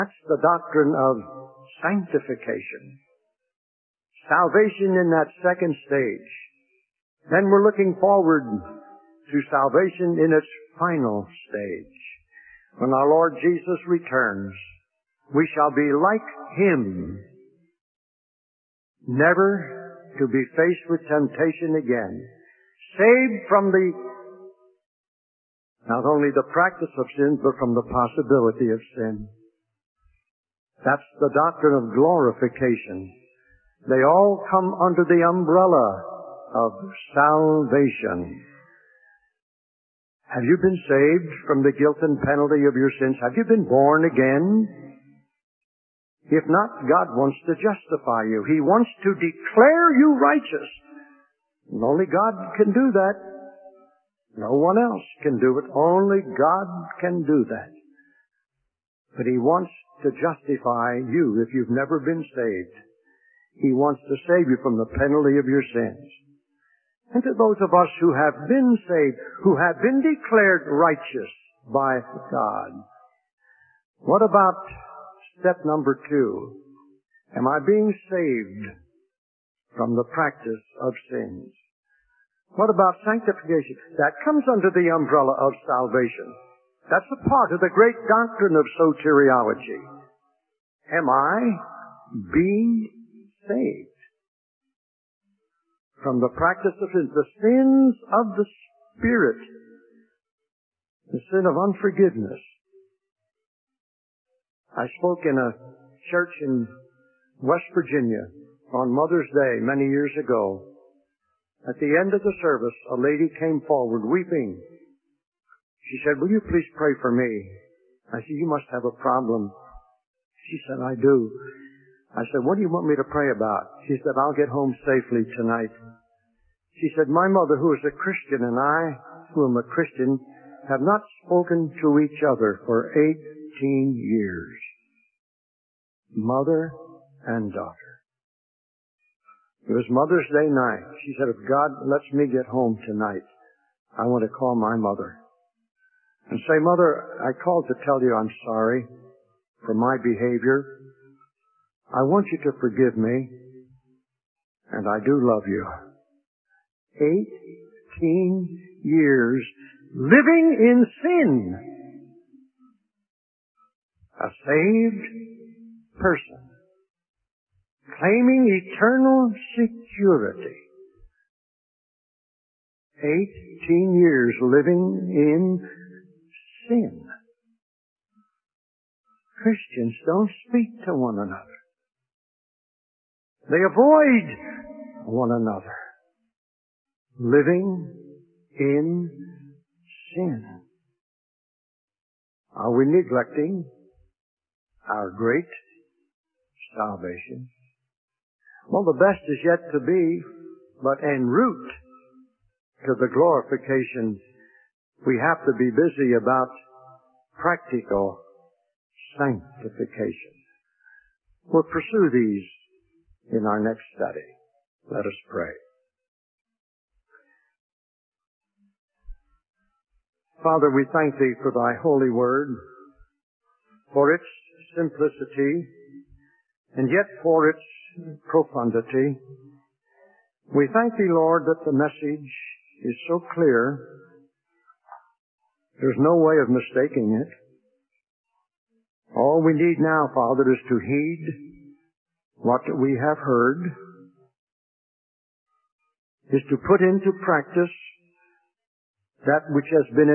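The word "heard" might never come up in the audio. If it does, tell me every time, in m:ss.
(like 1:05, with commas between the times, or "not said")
4:03.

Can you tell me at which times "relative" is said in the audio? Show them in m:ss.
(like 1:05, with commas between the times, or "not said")
not said.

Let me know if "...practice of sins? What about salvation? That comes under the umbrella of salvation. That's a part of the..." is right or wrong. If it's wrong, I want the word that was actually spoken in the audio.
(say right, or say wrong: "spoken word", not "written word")
wrong: "sanctification", not "salvation".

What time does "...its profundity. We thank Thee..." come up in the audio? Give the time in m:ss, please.
3:47.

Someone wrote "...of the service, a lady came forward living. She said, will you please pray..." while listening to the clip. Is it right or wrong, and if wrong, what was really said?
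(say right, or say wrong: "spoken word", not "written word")
wrong: "weeping", not "living".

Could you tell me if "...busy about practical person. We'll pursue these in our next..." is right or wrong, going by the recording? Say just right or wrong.
wrong.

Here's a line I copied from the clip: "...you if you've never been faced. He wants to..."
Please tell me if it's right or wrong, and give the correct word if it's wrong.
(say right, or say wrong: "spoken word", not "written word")
wrong: "saved", not "faced".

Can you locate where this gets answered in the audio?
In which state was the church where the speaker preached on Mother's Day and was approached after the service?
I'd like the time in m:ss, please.
1:47.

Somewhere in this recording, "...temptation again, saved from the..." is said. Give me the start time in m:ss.
0:21.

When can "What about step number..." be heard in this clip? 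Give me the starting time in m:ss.
1:13.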